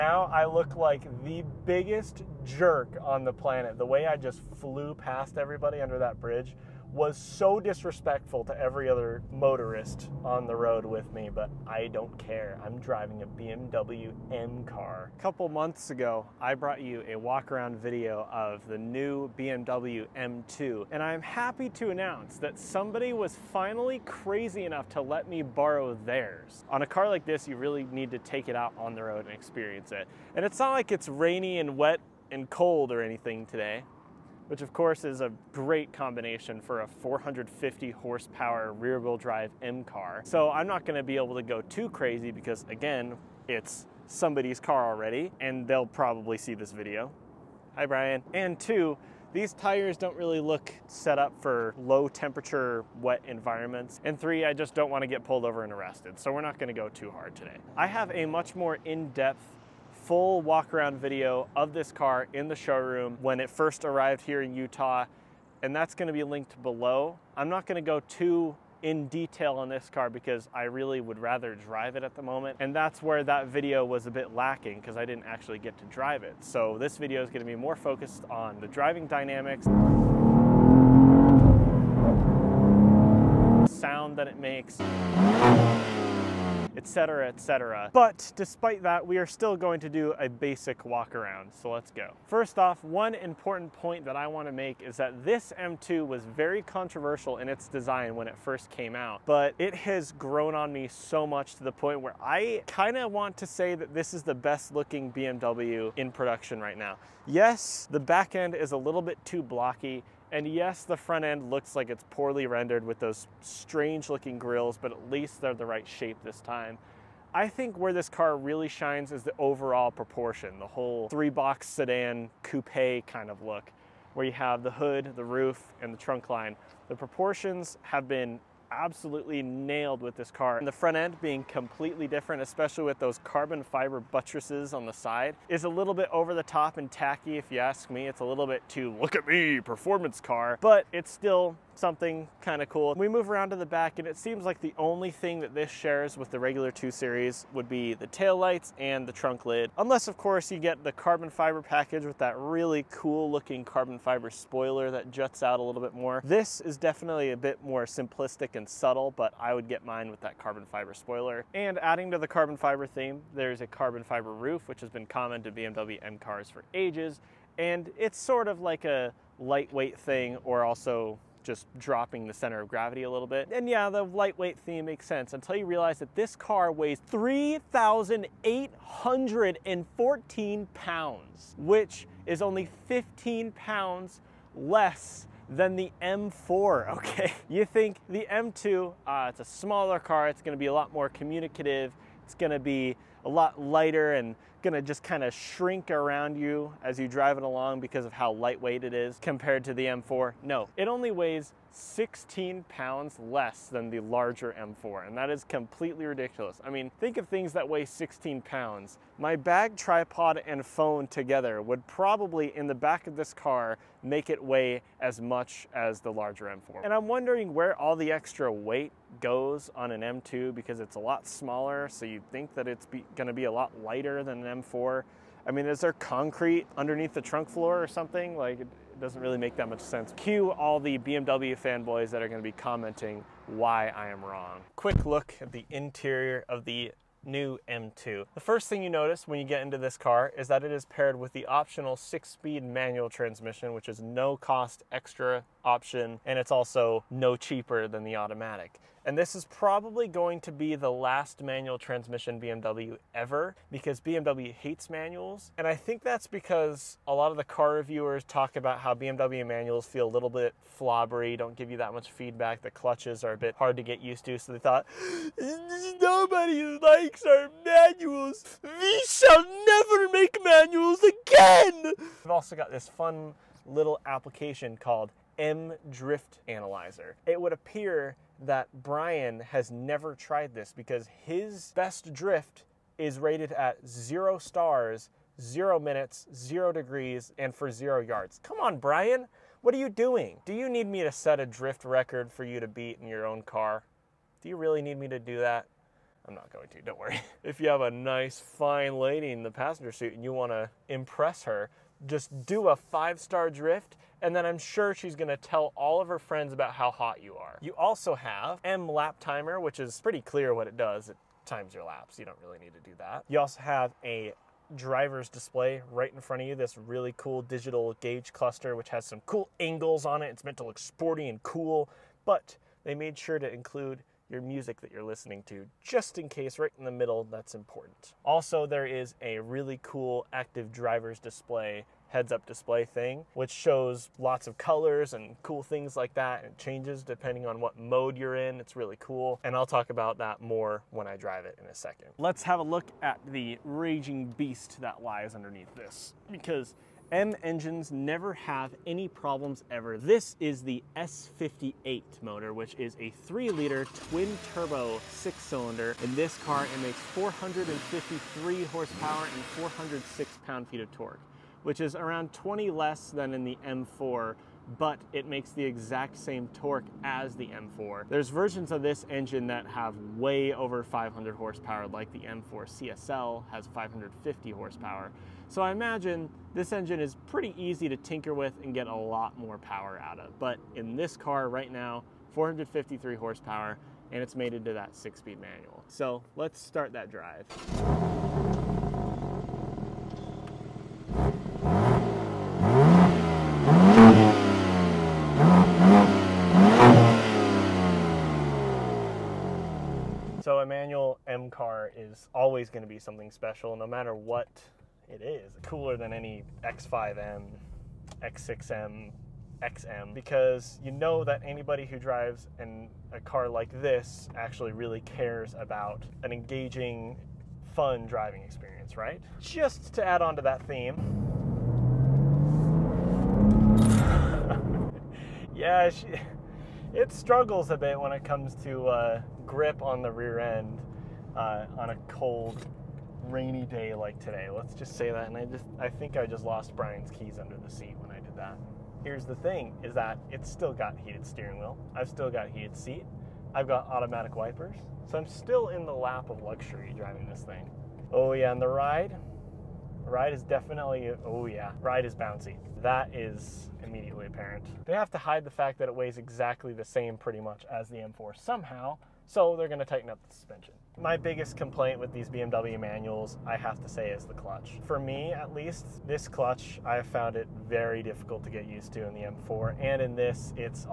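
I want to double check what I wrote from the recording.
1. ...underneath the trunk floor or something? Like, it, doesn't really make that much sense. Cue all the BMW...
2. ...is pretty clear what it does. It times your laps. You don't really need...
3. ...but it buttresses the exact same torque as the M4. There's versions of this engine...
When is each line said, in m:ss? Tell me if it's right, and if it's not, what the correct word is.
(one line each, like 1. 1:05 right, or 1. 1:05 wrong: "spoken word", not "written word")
1. 3:46 right
2. 5:09 right
3. 6:04 wrong: "makes", not "buttresses".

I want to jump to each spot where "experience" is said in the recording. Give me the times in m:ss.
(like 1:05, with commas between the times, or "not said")
0:29, 6:58.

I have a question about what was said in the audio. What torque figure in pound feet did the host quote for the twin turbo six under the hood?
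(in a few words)
406 pound feet.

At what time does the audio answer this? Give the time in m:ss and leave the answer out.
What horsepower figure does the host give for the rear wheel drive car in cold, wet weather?
0:36.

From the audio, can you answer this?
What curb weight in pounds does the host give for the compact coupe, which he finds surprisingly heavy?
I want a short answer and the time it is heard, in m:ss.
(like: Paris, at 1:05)
3,814 pounds, at 2:57.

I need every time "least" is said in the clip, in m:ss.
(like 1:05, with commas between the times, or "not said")
1:55, 7:45.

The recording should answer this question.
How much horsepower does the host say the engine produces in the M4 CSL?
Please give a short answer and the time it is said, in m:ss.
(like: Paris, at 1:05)
550, at 6:13.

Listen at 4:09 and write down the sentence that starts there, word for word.
And this is probably going to be the last manual transmission BMW ever because BMW hates manuals.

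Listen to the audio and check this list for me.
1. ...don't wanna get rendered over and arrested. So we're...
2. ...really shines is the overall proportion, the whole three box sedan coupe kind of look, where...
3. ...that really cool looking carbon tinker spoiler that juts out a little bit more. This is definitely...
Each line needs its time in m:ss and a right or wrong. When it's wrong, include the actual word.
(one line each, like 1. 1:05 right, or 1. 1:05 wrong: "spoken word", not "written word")
1. 0:54 wrong: "pulled", not "rendered"
2. 1:58 right
3. 2:32 wrong: "fiber", not "tinker".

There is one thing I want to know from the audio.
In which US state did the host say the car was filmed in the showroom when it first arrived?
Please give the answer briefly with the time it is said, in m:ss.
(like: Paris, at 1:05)
Utah, at 1:04.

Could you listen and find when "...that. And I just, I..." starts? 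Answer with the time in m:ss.
7:15.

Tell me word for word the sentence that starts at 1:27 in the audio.
But despite that, we are still going to do a basic walk around, so let's go.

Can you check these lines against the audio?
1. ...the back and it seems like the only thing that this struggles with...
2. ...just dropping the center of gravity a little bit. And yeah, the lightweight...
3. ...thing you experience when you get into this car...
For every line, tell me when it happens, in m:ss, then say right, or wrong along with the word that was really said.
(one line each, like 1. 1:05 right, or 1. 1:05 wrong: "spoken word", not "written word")
1. 2:23 wrong: "shares", not "struggles"
2. 2:51 right
3. 3:58 wrong: "notice", not "experience".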